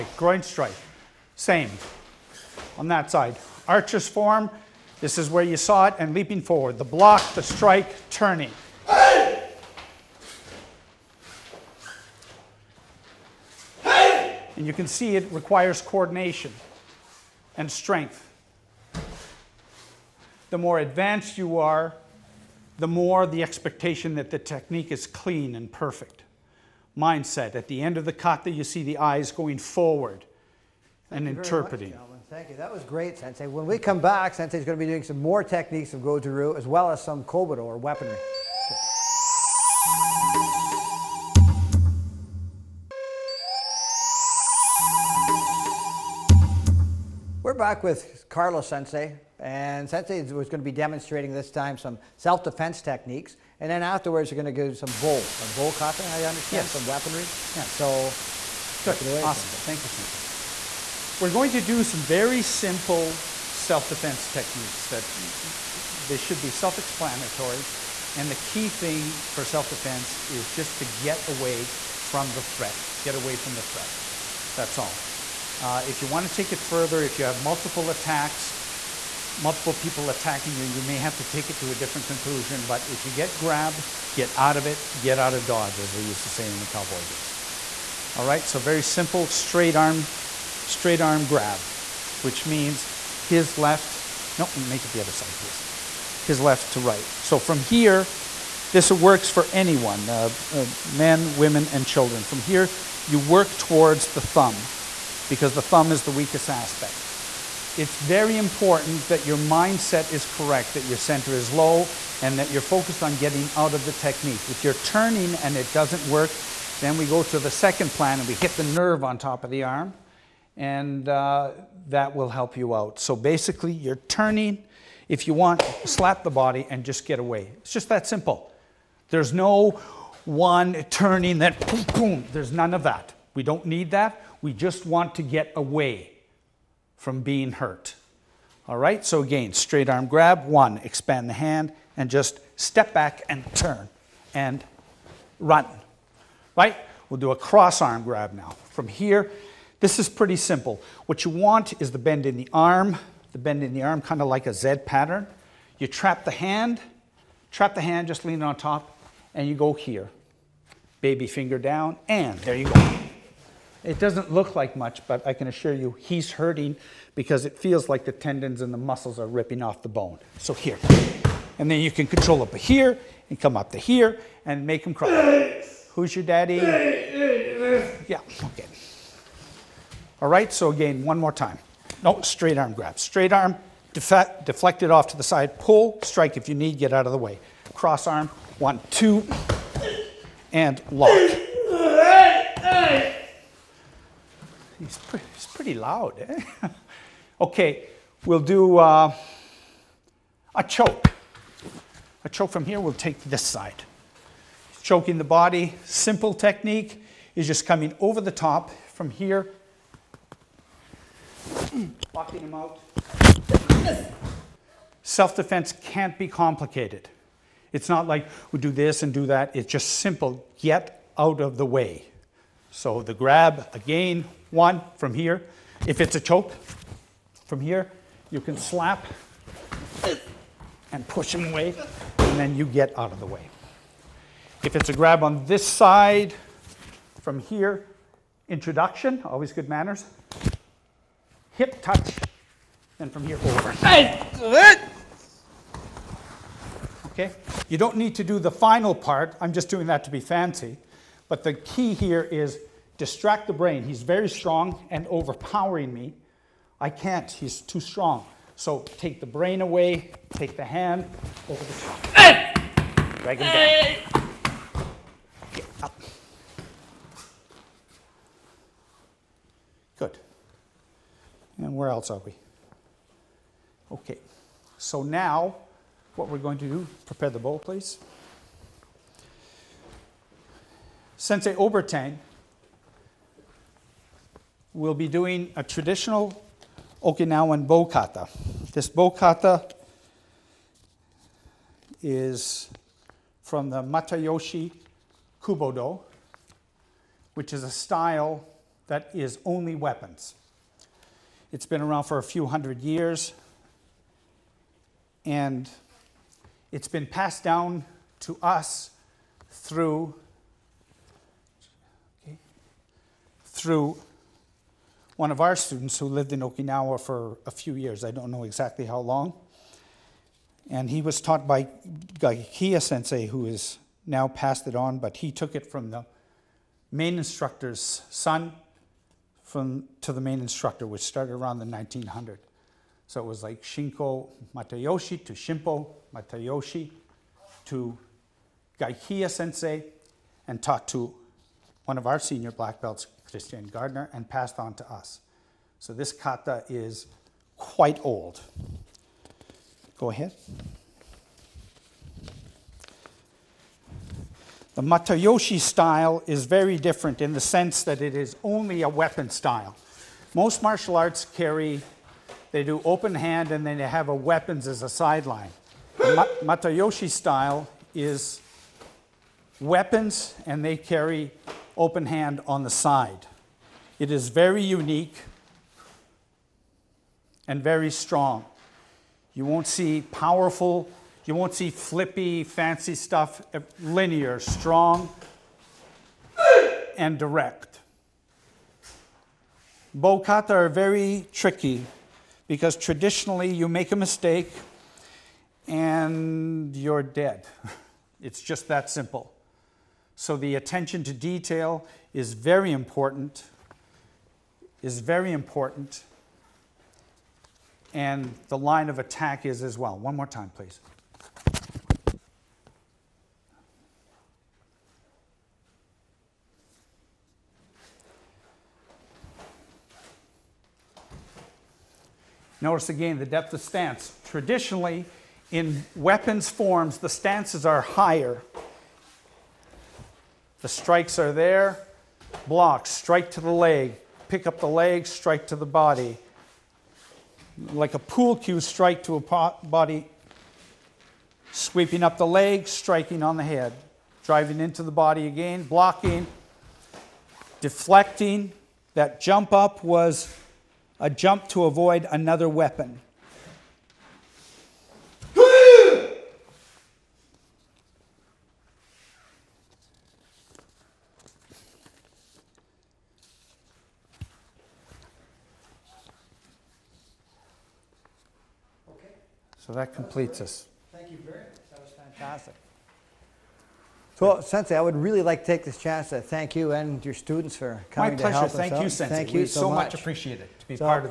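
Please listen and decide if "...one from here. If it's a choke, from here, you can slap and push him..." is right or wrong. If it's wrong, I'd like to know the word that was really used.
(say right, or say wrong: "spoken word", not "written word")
right.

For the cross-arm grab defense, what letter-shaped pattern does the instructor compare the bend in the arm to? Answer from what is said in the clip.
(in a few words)
Z pattern.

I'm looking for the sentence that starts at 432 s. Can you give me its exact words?
Block, strike to the leg, pick up the leg, strike to the body.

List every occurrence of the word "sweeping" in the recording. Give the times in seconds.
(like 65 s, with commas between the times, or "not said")
441 s.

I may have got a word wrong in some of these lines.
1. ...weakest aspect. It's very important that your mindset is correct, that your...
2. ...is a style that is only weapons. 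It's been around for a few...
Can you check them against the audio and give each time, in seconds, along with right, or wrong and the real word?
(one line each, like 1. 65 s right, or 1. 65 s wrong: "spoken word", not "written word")
1. 106 s right
2. 297 s right.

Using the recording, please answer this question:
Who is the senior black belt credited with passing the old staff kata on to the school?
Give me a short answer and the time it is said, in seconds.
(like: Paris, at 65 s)
Christian Gardner, at 343 s.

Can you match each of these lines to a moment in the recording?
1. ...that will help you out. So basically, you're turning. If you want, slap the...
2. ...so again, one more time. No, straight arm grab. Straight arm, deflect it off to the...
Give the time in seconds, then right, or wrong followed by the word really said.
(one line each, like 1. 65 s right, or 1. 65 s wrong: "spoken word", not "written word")
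1. 121 s right
2. 180 s right.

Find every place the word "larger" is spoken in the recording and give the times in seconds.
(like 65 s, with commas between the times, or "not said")
not said.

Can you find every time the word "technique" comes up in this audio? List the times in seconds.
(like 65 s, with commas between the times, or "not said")
24 s, 35 s, 52 s, 64 s, 113 s, 206 s.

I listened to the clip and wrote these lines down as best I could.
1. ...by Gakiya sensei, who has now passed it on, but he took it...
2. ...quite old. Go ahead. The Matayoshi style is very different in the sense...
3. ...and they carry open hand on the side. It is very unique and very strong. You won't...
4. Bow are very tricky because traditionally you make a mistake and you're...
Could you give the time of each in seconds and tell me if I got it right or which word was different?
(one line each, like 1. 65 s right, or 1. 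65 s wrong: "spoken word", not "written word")
1. 321 s right
2. 347 s right
3. 370 s right
4. 389 s right.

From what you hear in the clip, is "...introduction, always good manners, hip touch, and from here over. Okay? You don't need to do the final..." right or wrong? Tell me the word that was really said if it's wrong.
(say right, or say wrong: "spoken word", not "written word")
right.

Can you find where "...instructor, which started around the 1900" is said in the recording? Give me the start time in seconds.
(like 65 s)
330 s.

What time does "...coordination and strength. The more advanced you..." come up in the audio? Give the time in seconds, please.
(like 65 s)
15 s.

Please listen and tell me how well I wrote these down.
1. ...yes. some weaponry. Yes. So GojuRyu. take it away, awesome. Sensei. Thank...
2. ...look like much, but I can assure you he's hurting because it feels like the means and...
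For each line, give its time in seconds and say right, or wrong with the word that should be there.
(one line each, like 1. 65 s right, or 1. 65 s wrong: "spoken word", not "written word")
1. 56 s wrong: "Good", not "GojuRyu"
2. 164 s wrong: "tendons", not "means".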